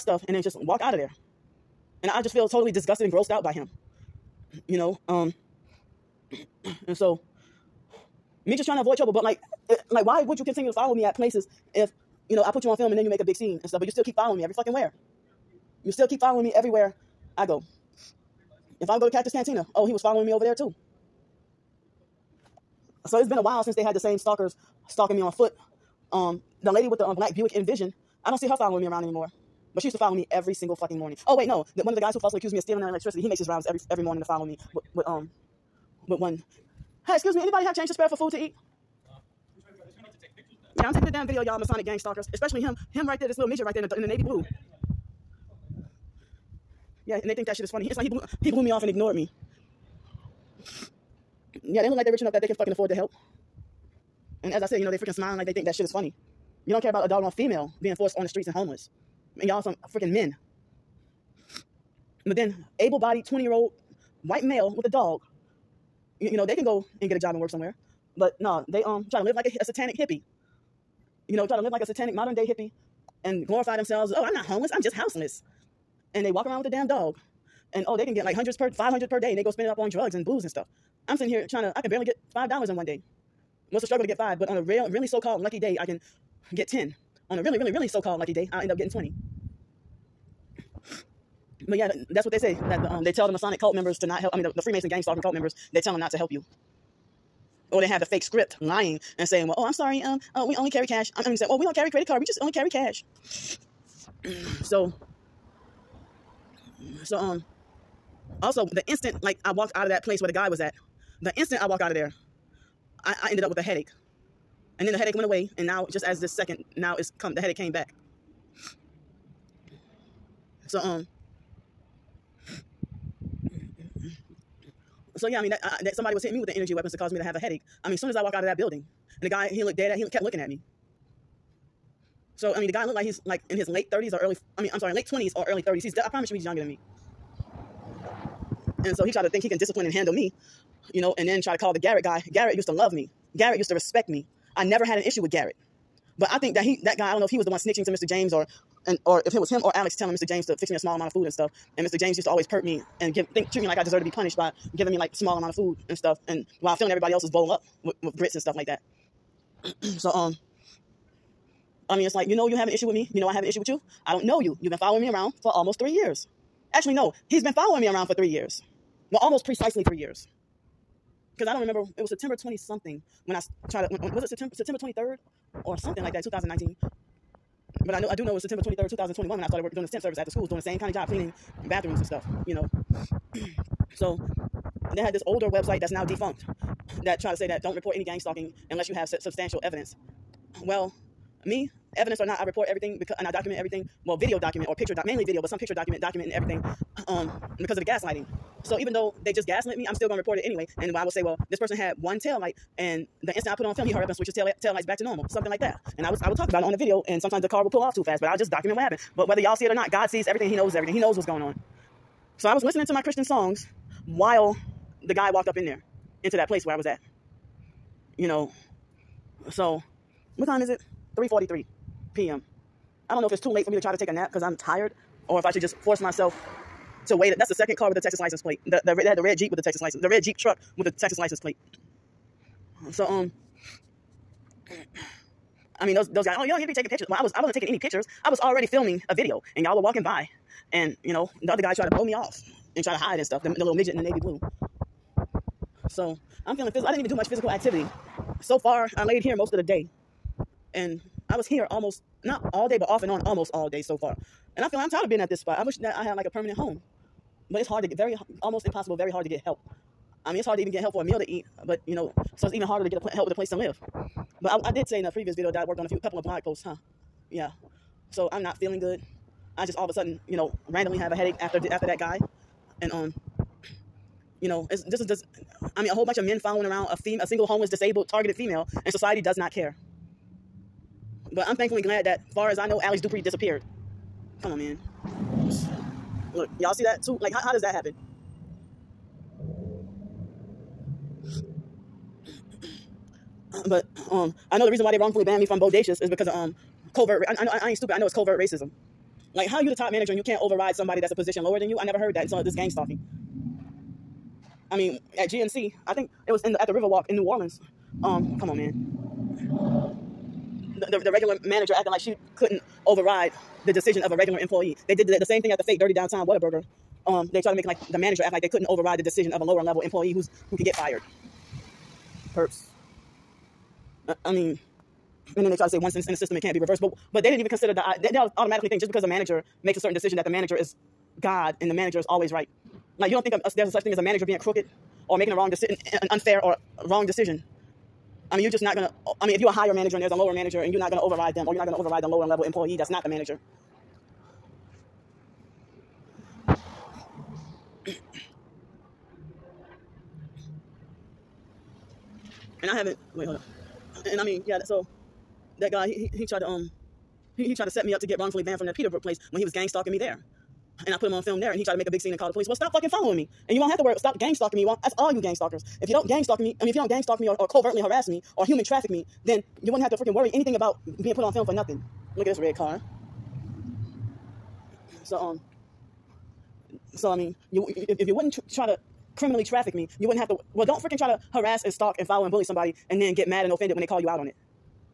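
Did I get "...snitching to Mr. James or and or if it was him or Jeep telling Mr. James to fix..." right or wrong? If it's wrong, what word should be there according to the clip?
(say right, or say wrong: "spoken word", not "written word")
wrong: "Alex", not "Jeep".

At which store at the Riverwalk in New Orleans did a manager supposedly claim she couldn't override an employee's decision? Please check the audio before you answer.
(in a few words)
GNC.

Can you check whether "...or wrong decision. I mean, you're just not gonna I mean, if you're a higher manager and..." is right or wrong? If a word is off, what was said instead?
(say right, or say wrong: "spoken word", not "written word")
right.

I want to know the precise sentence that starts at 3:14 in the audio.
Well, video document or picture doc, mainly video, but some picture document documenting everything.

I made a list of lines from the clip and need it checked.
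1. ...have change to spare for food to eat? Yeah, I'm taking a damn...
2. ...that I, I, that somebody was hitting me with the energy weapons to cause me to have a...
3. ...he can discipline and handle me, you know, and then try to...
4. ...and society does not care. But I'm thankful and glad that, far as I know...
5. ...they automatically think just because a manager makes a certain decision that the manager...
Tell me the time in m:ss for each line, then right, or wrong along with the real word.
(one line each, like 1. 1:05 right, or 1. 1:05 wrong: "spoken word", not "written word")
1. 0:37 right
2. 2:05 right
3. 2:19 right
4. 4:38 right
5. 5:28 right.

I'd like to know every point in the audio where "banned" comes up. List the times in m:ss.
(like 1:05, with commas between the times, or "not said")
4:55, 5:58.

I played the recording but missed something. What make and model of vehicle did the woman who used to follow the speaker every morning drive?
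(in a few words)
Buick Envision.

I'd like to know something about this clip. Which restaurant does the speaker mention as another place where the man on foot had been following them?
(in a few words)
Cactus Cantina.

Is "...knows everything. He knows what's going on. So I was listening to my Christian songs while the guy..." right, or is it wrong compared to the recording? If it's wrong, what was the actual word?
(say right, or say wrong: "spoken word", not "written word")
right.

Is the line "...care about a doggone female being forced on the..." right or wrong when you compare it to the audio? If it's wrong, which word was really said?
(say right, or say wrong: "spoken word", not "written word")
right.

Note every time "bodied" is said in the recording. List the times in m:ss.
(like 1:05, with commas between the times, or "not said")
1:02.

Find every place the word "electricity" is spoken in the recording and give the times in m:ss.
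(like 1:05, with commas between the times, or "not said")
0:32.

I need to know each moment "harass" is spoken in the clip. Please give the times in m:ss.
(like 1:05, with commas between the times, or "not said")
6:07, 6:21.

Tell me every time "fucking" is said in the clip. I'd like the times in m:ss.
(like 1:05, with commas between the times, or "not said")
0:14, 0:30, 0:52, 6:02.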